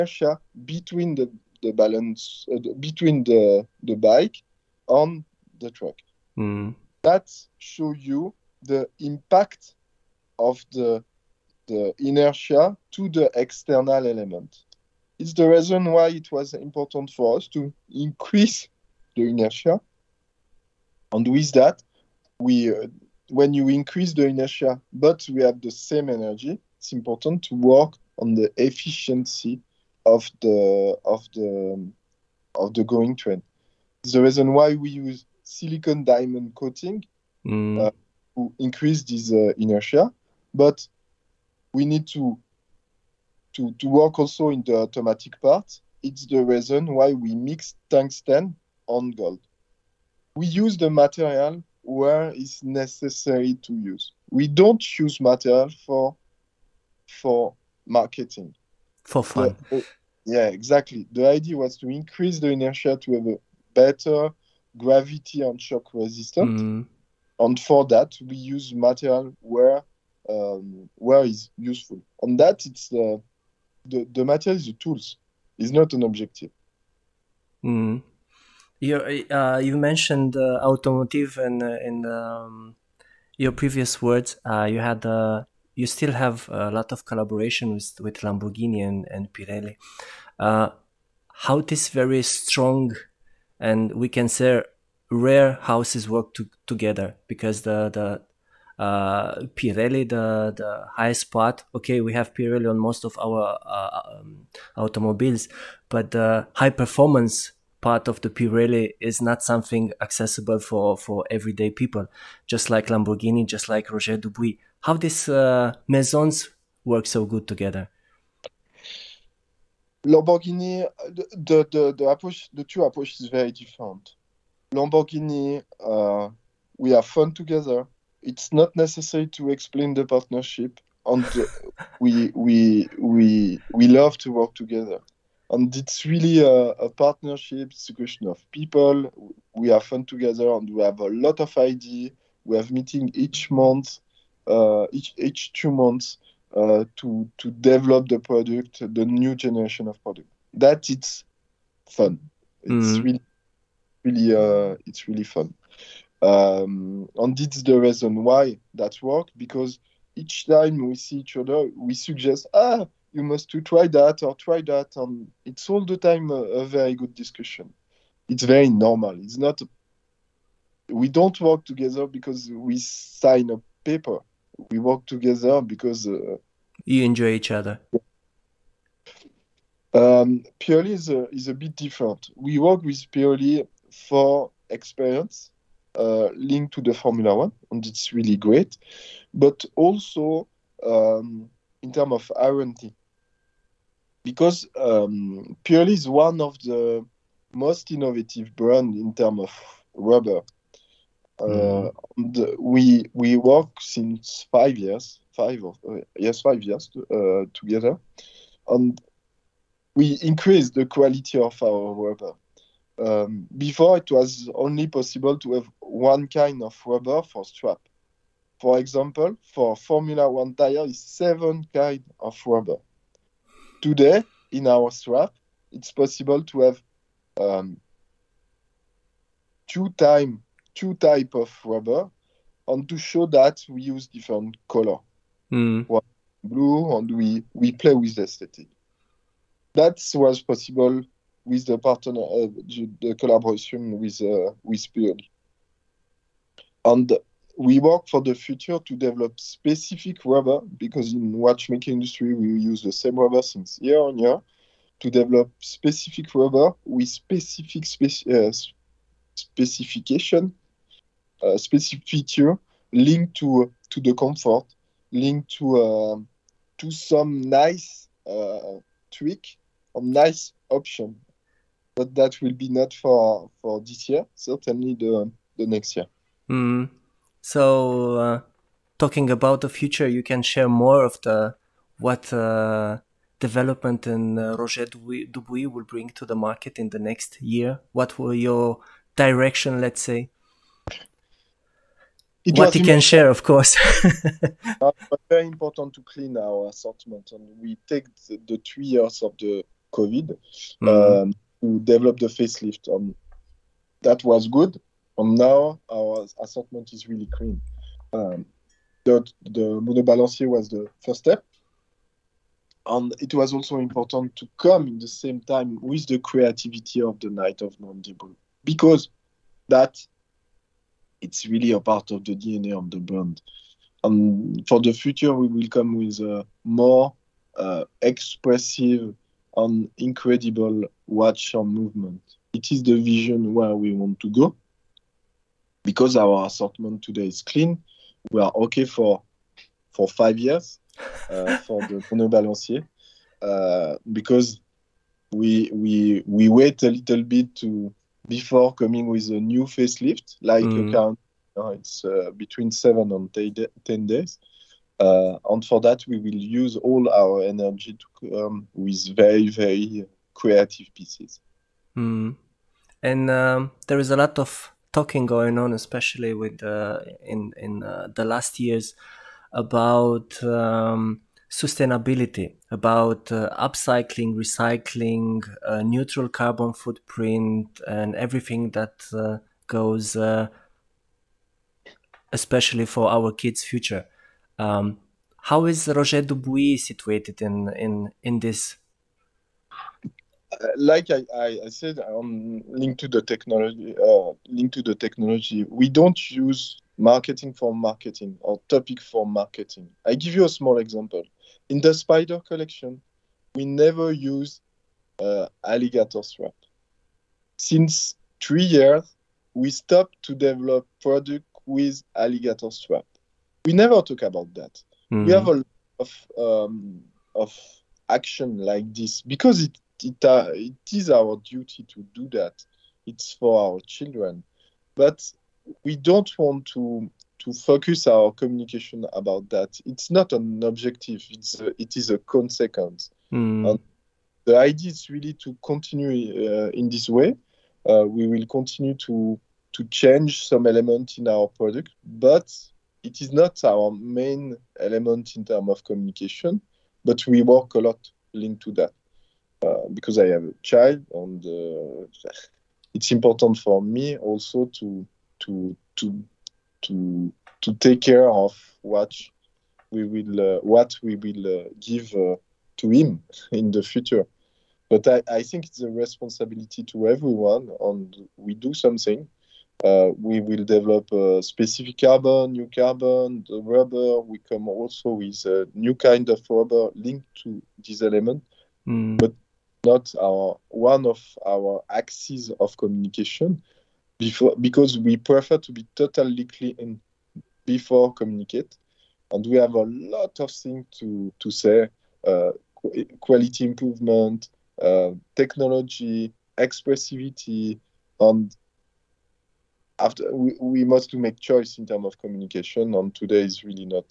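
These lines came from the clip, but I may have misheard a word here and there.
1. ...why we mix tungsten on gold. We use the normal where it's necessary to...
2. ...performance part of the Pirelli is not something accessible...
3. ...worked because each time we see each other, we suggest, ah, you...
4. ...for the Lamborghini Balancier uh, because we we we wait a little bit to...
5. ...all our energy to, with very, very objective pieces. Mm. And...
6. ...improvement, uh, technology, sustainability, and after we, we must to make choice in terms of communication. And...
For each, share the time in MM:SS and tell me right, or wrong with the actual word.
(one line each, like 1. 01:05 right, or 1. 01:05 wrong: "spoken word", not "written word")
1. 00:46 wrong: "material", not "normal"
2. 01:46 right
3. 02:39 right
4. 05:41 wrong: "Mono", not "Lamborghini"
5. 05:56 wrong: "creative", not "objective"
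6. 08:13 wrong: "expressivity", not "sustainability".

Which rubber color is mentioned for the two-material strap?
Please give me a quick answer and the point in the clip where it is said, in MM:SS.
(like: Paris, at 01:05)
blue, at 03:56.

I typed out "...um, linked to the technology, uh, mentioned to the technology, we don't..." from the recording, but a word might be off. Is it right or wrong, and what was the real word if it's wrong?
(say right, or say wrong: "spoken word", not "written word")
wrong: "linked", not "mentioned".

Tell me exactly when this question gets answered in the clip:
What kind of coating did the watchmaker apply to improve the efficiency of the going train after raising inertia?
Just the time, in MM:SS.
00:35.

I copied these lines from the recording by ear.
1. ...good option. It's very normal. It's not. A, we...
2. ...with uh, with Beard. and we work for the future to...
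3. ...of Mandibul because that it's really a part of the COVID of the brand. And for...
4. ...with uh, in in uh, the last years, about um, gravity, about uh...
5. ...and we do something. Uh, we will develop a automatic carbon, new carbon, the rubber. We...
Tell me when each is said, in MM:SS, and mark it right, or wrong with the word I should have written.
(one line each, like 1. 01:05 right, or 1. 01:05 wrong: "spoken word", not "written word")
1. 02:46 wrong: "discussion", not "option"
2. 04:03 right
3. 05:17 wrong: "DNA", not "COVID"
4. 06:06 wrong: "sustainability", not "gravity"
5. 07:47 wrong: "specific", not "automatic".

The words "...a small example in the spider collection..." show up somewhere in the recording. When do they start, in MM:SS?
06:40.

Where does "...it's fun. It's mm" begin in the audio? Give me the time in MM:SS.
02:30.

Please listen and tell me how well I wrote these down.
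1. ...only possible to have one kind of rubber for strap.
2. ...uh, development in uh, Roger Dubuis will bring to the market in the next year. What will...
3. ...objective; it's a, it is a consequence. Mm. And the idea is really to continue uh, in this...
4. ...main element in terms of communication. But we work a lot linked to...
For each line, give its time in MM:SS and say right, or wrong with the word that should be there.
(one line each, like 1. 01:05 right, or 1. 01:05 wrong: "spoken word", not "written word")
1. 03:34 right
2. 04:42 right
3. 07:10 right
4. 07:23 right.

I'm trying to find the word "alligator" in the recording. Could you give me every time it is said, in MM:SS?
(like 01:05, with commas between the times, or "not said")
06:45, 06:52.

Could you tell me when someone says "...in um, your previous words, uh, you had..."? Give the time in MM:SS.
01:21.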